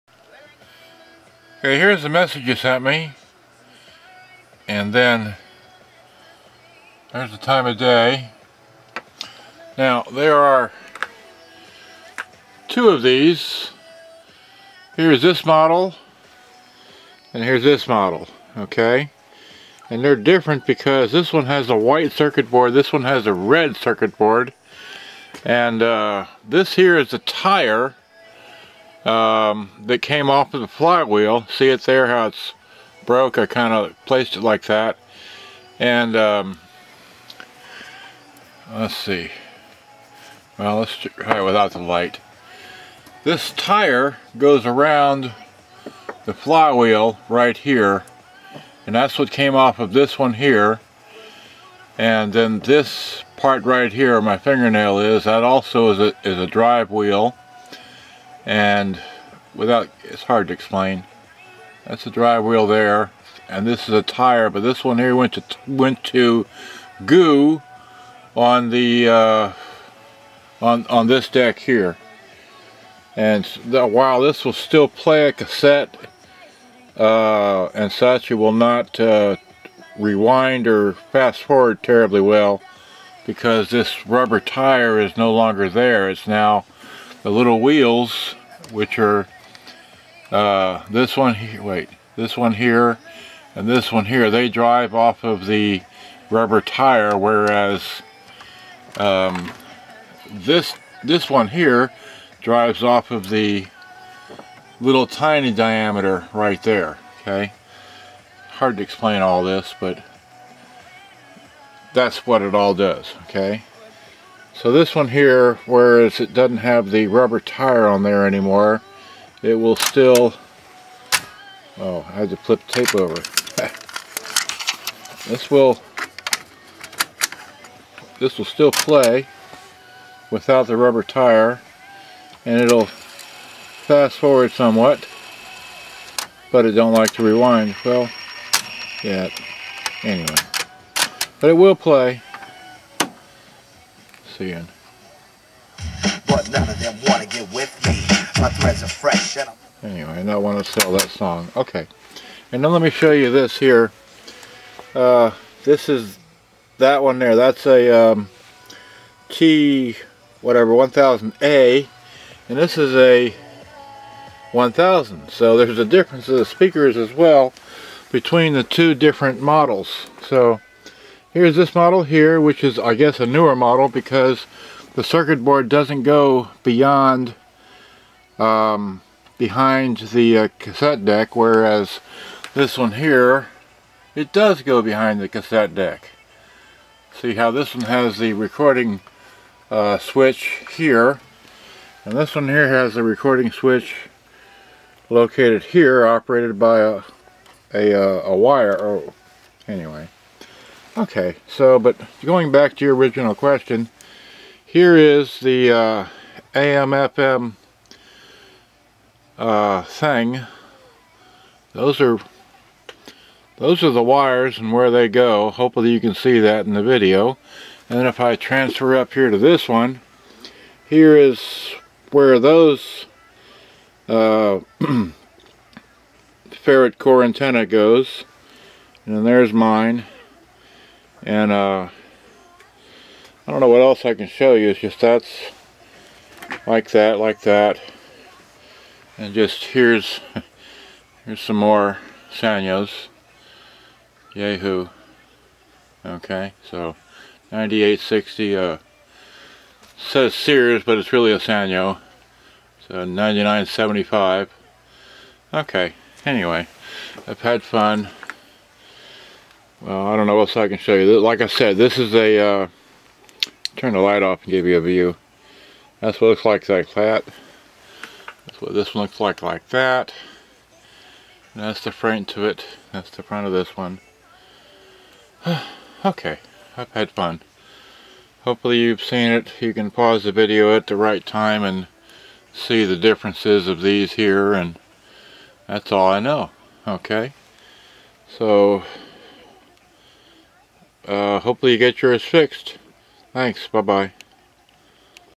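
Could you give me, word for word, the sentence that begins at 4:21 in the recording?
Like I said, this is a, uh, turn the light off and give you a view.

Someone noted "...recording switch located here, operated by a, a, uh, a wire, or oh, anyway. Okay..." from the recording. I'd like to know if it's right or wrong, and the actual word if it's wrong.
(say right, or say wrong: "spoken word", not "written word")
right.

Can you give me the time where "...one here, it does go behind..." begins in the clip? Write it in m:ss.
3:02.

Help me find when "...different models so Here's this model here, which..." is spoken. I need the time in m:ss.
2:48.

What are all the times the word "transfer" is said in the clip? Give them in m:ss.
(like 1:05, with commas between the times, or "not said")
3:38.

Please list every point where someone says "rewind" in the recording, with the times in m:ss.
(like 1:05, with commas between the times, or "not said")
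1:19, 2:17.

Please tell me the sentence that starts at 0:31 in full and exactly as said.
See it there, how it's broke?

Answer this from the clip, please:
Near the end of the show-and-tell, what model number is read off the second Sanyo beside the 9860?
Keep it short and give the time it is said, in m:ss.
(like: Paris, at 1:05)
9975, at 4:13.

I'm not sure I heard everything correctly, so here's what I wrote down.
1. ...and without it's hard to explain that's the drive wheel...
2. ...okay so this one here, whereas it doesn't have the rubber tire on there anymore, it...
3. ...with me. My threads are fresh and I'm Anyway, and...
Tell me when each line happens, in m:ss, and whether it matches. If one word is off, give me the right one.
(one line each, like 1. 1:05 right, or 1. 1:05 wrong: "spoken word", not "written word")
1. 0:58 right
2. 1:53 right
3. 2:27 right.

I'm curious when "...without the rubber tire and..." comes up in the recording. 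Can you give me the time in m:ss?
2:10.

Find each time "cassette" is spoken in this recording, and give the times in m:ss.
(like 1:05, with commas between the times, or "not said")
1:15, 3:00, 3:05.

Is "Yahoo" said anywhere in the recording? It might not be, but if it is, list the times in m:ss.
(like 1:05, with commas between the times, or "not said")
4:04.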